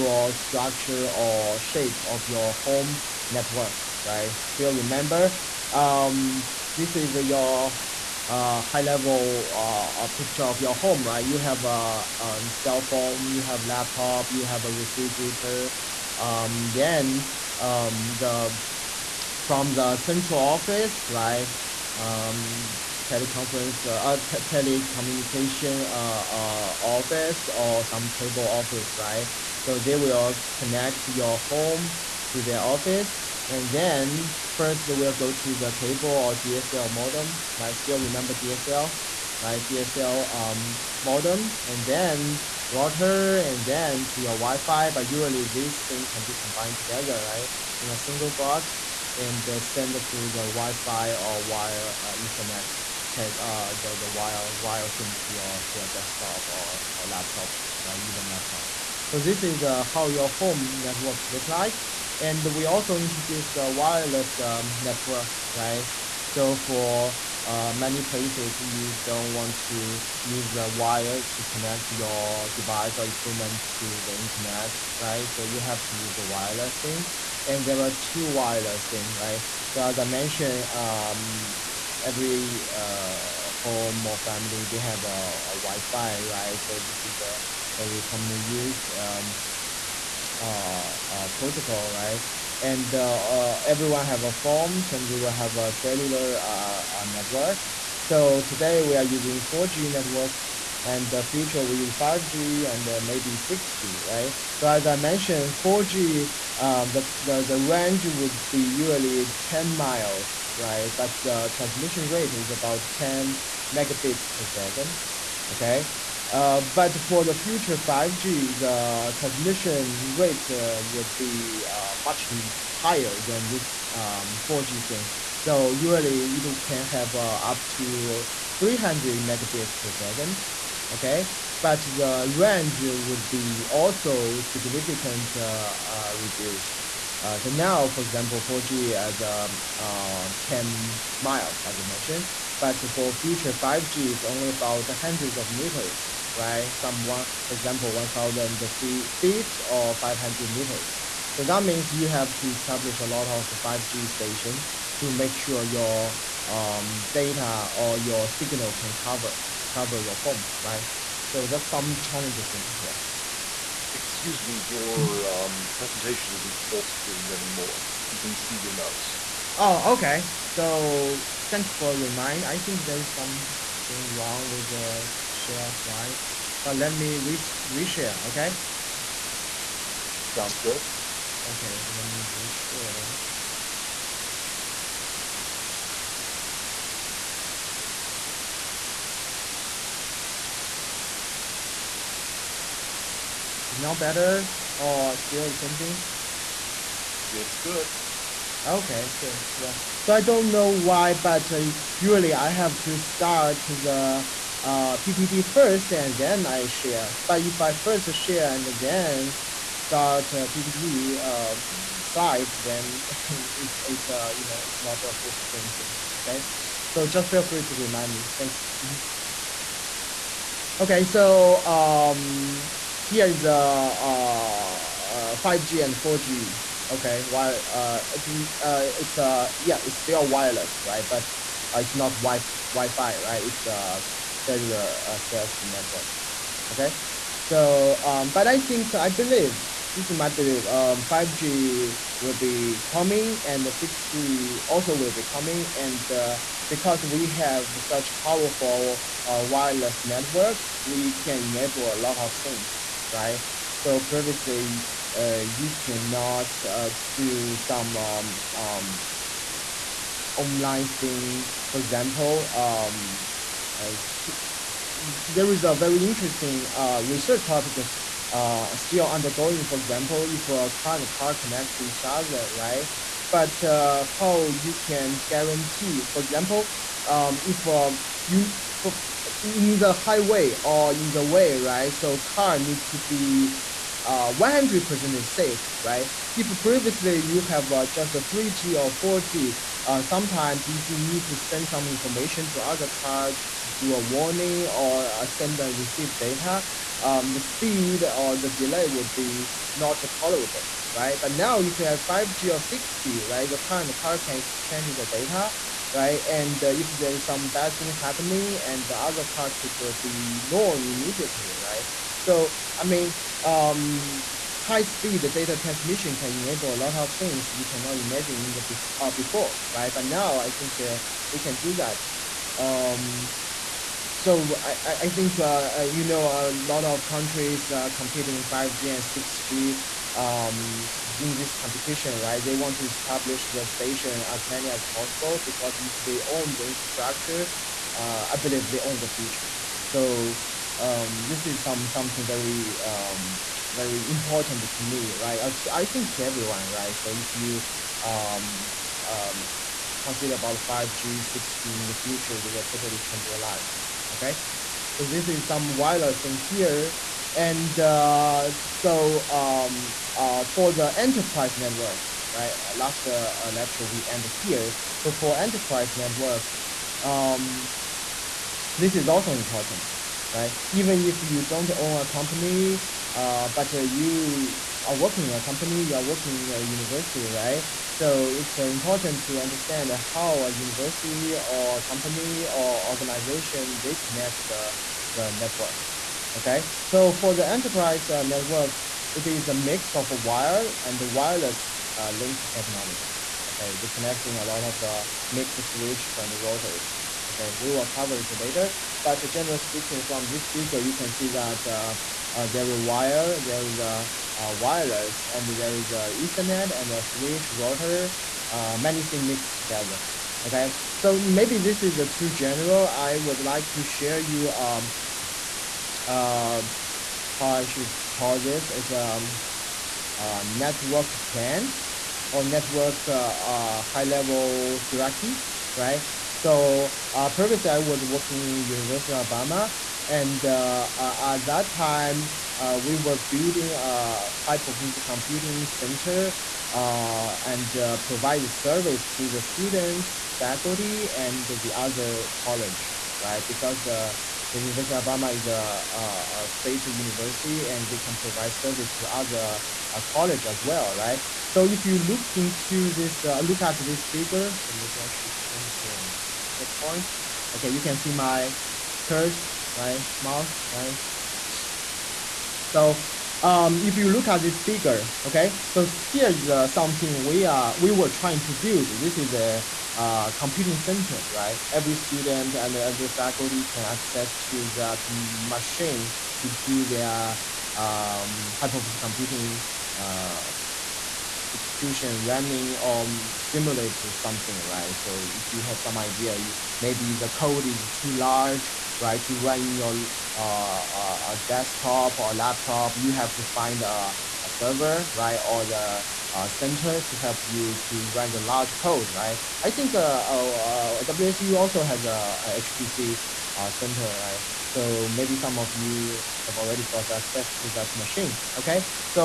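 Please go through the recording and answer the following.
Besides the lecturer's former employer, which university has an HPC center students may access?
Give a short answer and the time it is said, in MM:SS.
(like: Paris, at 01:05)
WSU, at 08:21.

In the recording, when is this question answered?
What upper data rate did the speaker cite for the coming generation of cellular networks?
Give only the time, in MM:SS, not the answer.
02:07.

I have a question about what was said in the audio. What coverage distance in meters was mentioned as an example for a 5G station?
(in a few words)
500 meters.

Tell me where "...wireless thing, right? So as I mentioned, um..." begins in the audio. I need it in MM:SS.
01:18.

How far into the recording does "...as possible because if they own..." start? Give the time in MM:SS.
05:34.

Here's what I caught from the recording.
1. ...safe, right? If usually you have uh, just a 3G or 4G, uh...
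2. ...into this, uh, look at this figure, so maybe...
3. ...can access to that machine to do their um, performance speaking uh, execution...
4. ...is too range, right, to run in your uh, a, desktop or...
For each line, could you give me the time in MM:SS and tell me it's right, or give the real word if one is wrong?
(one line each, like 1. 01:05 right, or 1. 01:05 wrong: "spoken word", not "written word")
1. 04:45 wrong: "previously", not "usually"
2. 07:32 right
3. 07:53 wrong: "computing", not "speaking"
4. 08:07 wrong: "large", not "range".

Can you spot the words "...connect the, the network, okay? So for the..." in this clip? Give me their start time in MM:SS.
06:23.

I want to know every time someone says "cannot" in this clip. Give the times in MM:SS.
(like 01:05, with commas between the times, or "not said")
04:15, 05:17.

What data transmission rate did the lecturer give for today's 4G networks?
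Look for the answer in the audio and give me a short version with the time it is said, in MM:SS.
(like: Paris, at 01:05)
10 megabits per second, at 01:52.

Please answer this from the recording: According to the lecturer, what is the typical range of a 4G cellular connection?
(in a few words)
10 miles.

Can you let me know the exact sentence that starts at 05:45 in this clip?
Uh, to, I think to everyone, right?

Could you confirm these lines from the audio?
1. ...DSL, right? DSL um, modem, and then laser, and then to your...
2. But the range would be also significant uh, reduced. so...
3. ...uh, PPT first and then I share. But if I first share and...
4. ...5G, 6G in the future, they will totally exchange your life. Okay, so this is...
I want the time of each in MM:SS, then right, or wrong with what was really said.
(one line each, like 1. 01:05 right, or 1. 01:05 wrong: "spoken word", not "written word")
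1. 00:38 wrong: "router", not "laser"
2. 02:11 right
3. 03:24 right
4. 05:50 wrong: "change", not "exchange".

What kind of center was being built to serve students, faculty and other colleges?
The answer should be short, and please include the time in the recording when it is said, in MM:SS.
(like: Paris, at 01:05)
high performance computing center, at 07:14.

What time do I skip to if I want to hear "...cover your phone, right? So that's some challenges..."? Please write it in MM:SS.
02:39.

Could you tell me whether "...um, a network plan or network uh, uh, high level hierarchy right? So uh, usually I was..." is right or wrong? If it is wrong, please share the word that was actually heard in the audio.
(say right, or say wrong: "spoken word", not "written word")
wrong: "previously", not "usually".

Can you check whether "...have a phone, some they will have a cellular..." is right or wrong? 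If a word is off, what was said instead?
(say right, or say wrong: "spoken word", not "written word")
right.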